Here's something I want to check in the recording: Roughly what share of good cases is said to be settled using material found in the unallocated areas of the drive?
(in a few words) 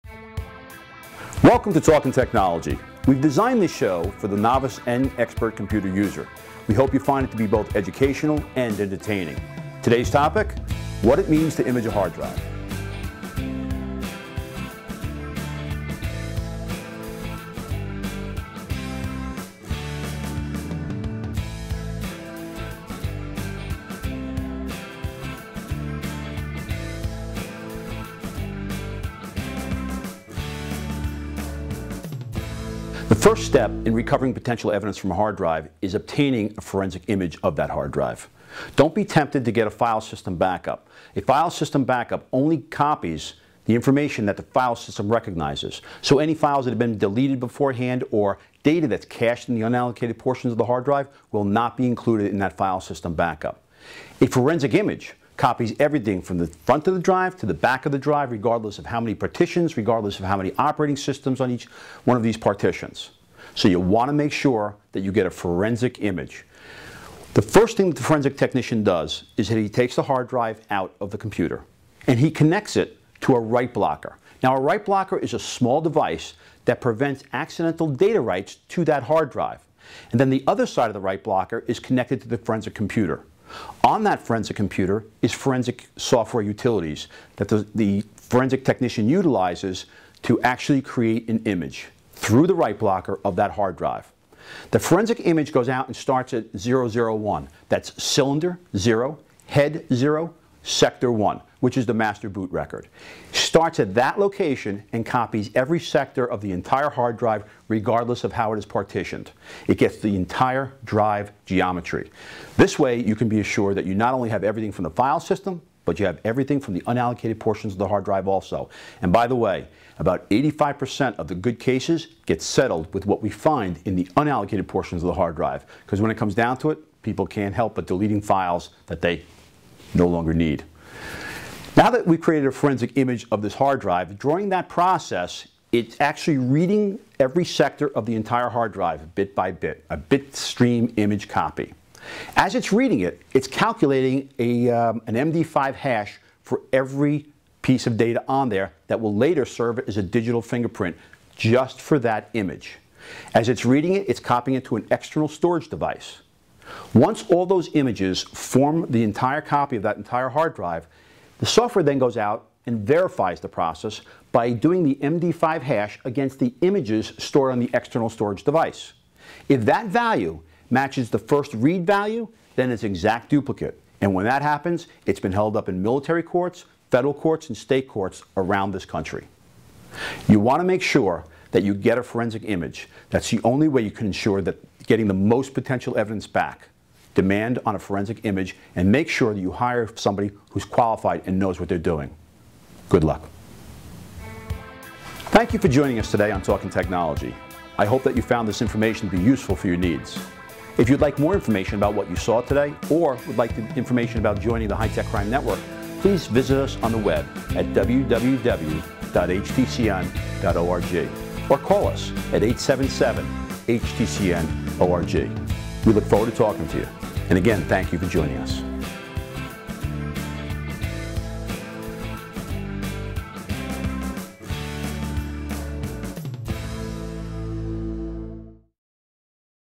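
85%.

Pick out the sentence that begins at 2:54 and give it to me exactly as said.
And when that happens, it's been held up in military courts, federal courts, and state courts around this country.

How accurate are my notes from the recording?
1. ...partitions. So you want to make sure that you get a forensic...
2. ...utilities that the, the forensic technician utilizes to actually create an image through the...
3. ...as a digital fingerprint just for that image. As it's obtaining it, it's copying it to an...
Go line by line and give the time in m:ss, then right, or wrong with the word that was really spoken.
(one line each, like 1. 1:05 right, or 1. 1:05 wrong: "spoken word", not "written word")
1. 1:02 right
2. 1:26 right
3. 2:29 wrong: "reading", not "obtaining".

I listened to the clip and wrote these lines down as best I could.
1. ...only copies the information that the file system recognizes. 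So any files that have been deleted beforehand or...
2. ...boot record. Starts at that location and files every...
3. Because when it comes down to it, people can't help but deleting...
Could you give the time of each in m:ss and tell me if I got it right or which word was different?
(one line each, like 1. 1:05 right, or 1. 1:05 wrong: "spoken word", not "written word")
1. 0:42 right
2. 1:42 wrong: "copies", not "files"
3. 2:05 right.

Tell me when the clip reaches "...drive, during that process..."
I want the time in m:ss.
2:13.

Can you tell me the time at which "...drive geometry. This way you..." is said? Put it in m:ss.
1:50.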